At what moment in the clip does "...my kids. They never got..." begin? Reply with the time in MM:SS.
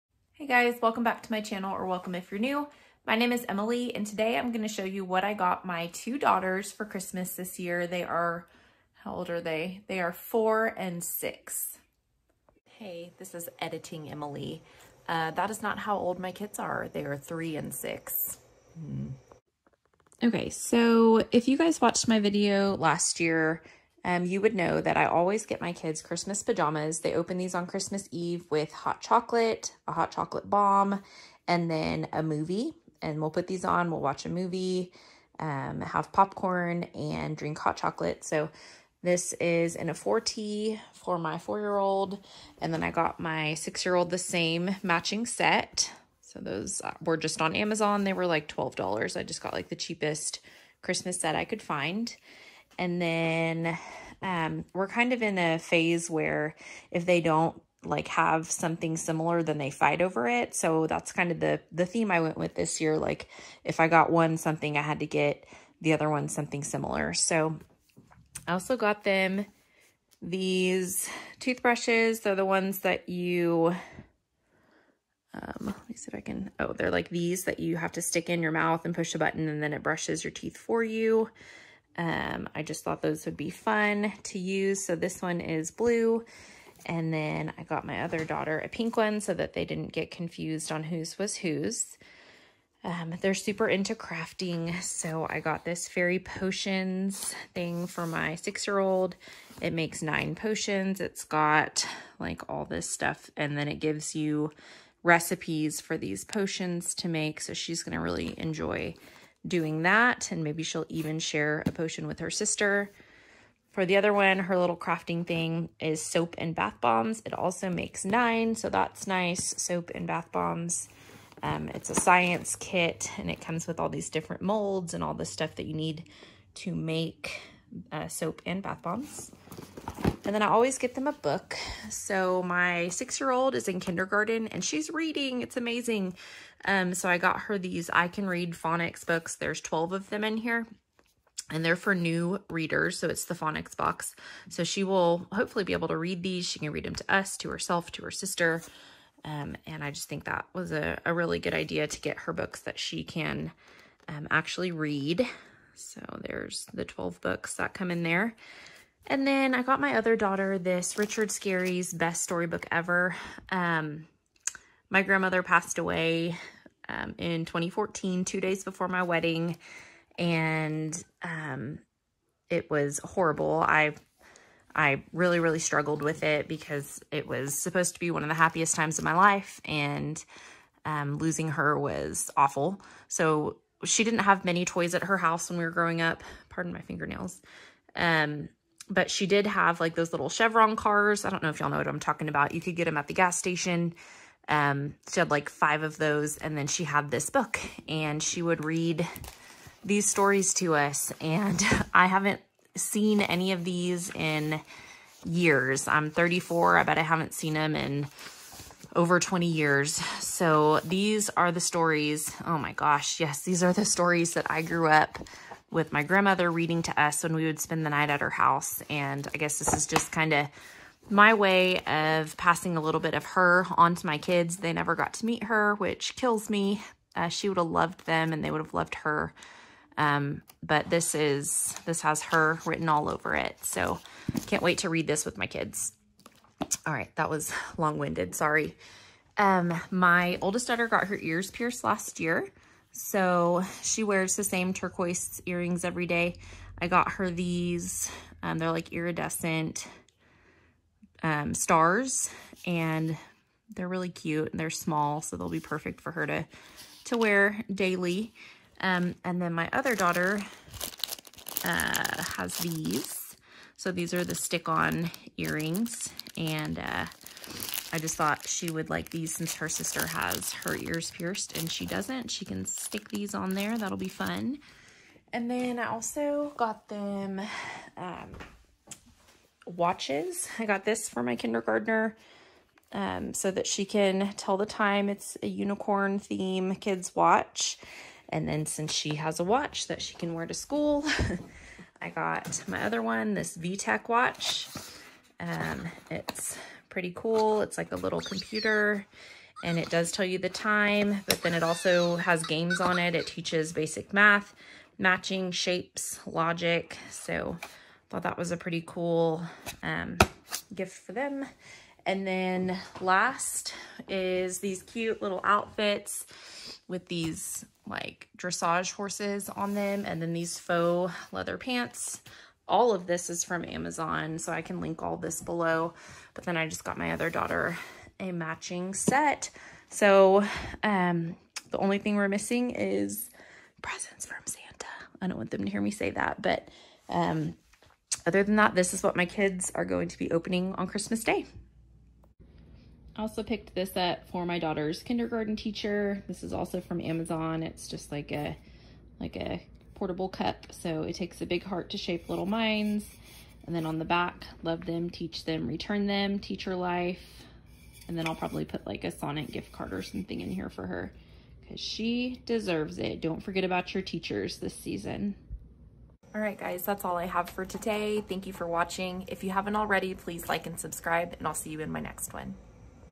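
03:44.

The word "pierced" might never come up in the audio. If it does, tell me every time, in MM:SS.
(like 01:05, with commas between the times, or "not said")
04:01, 04:31.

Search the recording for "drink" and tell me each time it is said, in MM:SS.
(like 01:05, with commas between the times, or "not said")
00:37.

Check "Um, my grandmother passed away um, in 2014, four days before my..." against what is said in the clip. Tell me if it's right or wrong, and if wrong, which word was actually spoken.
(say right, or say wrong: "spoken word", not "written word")
wrong: "two", not "four".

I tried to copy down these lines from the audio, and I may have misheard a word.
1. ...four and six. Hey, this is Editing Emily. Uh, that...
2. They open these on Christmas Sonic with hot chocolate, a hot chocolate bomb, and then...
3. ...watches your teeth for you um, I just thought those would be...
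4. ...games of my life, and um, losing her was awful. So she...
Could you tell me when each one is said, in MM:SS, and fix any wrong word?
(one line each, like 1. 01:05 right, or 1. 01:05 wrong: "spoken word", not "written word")
1. 00:10 right
2. 00:26 wrong: "Eve", not "Sonic"
3. 01:19 wrong: "brushes", not "watches"
4. 02:58 wrong: "times", not "games".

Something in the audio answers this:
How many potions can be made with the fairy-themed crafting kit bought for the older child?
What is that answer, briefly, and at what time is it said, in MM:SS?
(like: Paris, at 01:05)
9, at 01:40.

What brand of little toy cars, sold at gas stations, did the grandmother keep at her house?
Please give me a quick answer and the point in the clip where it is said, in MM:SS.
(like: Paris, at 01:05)
Chevron, at 03:10.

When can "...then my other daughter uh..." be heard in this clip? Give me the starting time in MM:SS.
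04:19.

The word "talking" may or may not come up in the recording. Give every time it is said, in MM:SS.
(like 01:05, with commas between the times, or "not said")
03:11.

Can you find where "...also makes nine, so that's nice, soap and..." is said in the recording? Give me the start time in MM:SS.
01:57.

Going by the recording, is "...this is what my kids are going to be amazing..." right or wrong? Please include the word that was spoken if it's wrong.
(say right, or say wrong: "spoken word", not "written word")
wrong: "opening", not "amazing".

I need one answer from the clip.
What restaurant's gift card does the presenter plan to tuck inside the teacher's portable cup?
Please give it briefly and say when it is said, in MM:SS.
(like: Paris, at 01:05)
Sonic, at 05:59.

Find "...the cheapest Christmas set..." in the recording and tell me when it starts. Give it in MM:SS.
00:49.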